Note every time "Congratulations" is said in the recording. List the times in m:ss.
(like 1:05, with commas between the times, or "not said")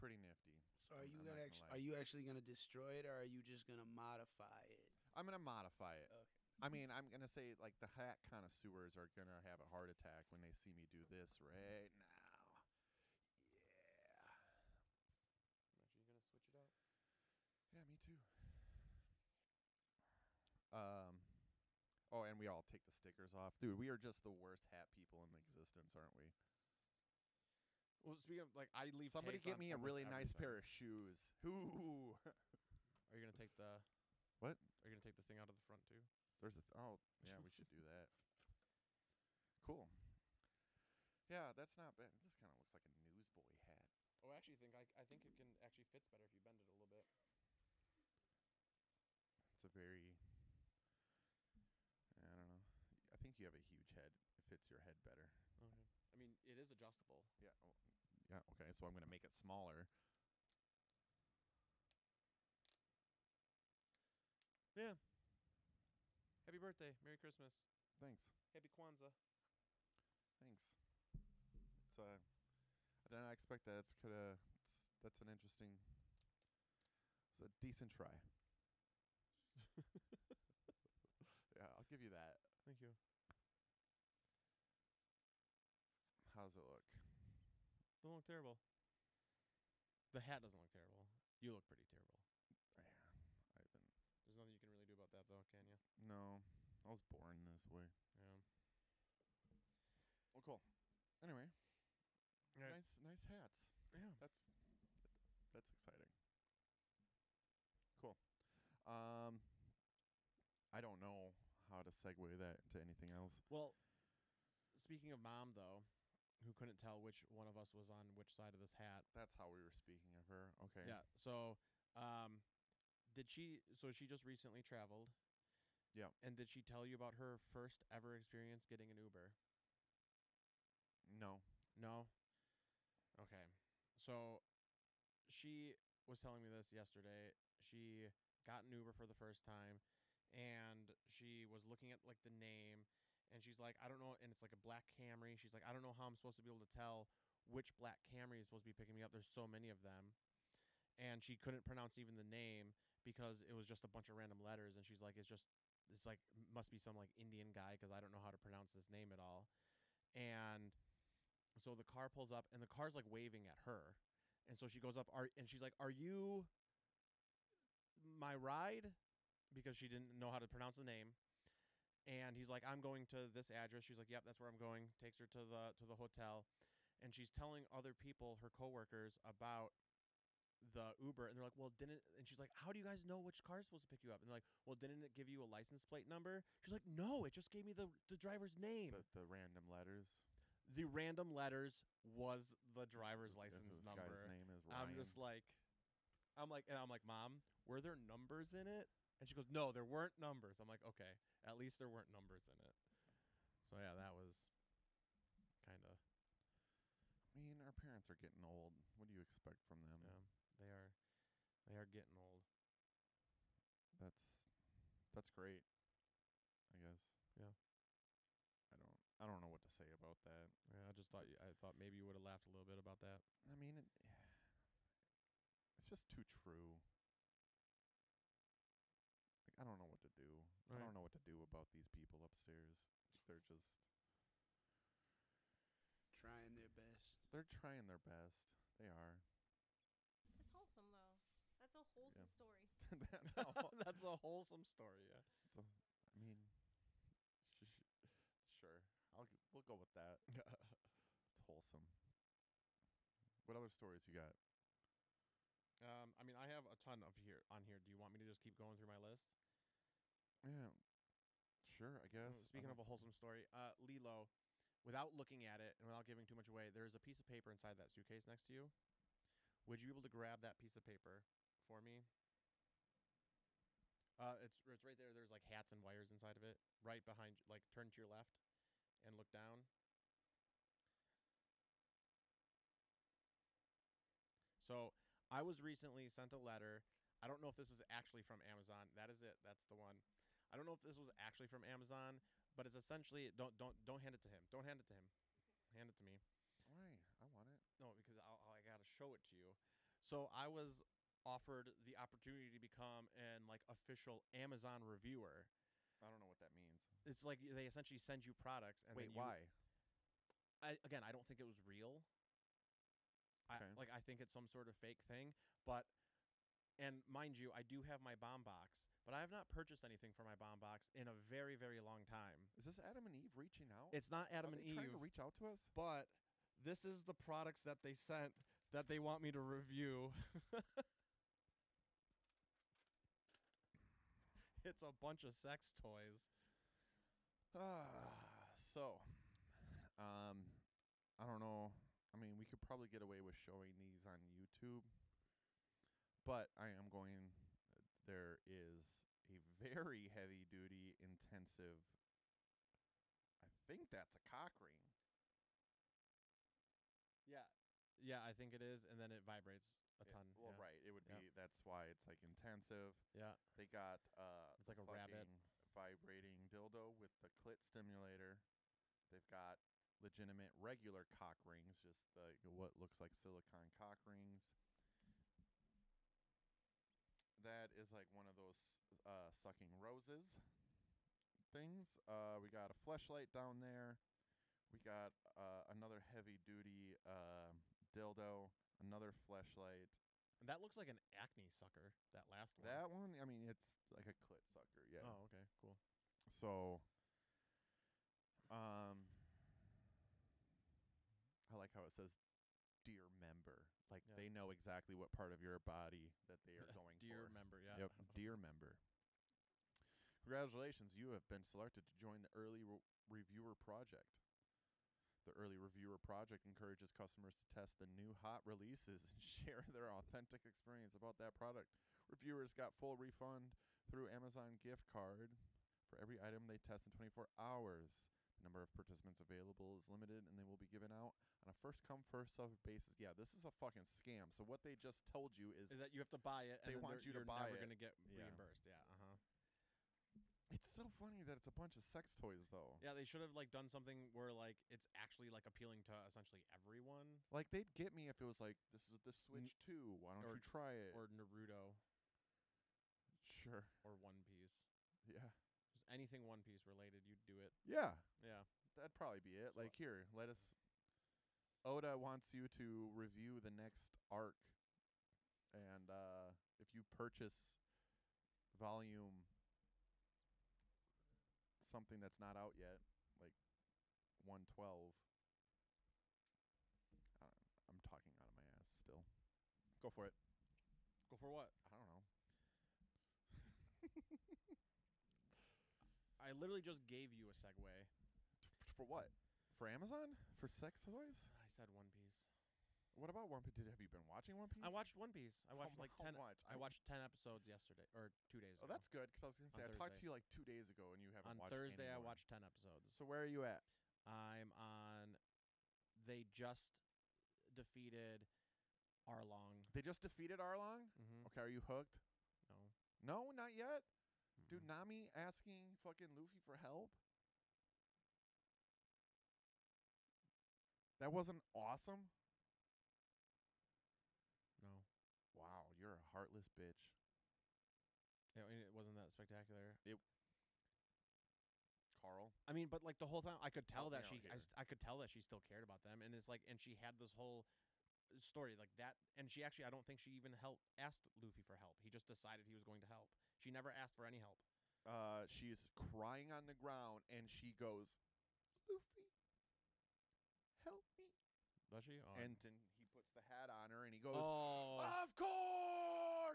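6:50.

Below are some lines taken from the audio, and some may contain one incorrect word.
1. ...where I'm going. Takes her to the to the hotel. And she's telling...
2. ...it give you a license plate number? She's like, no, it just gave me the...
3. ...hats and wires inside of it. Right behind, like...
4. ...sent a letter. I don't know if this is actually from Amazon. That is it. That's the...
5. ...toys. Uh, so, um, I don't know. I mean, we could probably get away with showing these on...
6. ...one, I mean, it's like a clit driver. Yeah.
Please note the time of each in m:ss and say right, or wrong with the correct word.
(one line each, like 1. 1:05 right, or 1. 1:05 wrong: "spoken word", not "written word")
1. 2:54 right
2. 3:05 right
3. 4:35 right
4. 4:46 right
5. 5:35 right
6. 6:32 wrong: "sucker", not "driver".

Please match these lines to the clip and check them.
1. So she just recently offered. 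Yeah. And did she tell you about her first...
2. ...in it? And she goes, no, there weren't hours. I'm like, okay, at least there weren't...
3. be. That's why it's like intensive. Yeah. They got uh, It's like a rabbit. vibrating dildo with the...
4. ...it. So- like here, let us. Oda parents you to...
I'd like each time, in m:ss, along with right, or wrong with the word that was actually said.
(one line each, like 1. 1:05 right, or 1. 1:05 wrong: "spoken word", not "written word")
1. 2:03 wrong: "traveled", not "offered"
2. 3:18 wrong: "numbers", not "hours"
3. 6:01 right
4. 7:39 wrong: "wants", not "parents".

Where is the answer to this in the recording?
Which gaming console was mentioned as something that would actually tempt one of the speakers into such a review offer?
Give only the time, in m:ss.
7:29.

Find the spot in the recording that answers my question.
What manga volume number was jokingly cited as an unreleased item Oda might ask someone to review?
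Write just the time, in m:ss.
7:54.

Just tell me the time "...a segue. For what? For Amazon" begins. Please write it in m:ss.
8:07.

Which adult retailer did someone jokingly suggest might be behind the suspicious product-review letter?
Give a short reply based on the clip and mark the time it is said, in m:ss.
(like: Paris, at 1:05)
Adam and Eve, at 5:22.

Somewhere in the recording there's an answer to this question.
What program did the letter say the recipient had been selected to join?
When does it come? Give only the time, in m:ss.
6:52.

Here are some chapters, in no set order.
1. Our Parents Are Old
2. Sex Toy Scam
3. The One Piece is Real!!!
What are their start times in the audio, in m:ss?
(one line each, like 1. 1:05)
1. 1:56
2. 4:20
3. 8:10.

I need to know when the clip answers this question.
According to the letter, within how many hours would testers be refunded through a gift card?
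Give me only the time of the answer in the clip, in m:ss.
7:06.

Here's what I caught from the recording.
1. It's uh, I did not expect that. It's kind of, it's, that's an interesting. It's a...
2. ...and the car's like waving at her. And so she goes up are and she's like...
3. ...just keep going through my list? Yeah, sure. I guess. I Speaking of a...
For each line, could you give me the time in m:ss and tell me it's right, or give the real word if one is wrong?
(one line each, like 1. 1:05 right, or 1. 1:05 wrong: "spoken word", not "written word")
1. 1:11 right
2. 2:42 right
3. 4:18 right.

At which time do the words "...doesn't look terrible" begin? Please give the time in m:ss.
1:30.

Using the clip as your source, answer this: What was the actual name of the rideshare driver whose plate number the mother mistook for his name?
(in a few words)
Ryan.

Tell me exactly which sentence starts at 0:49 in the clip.
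It's a very I don't know.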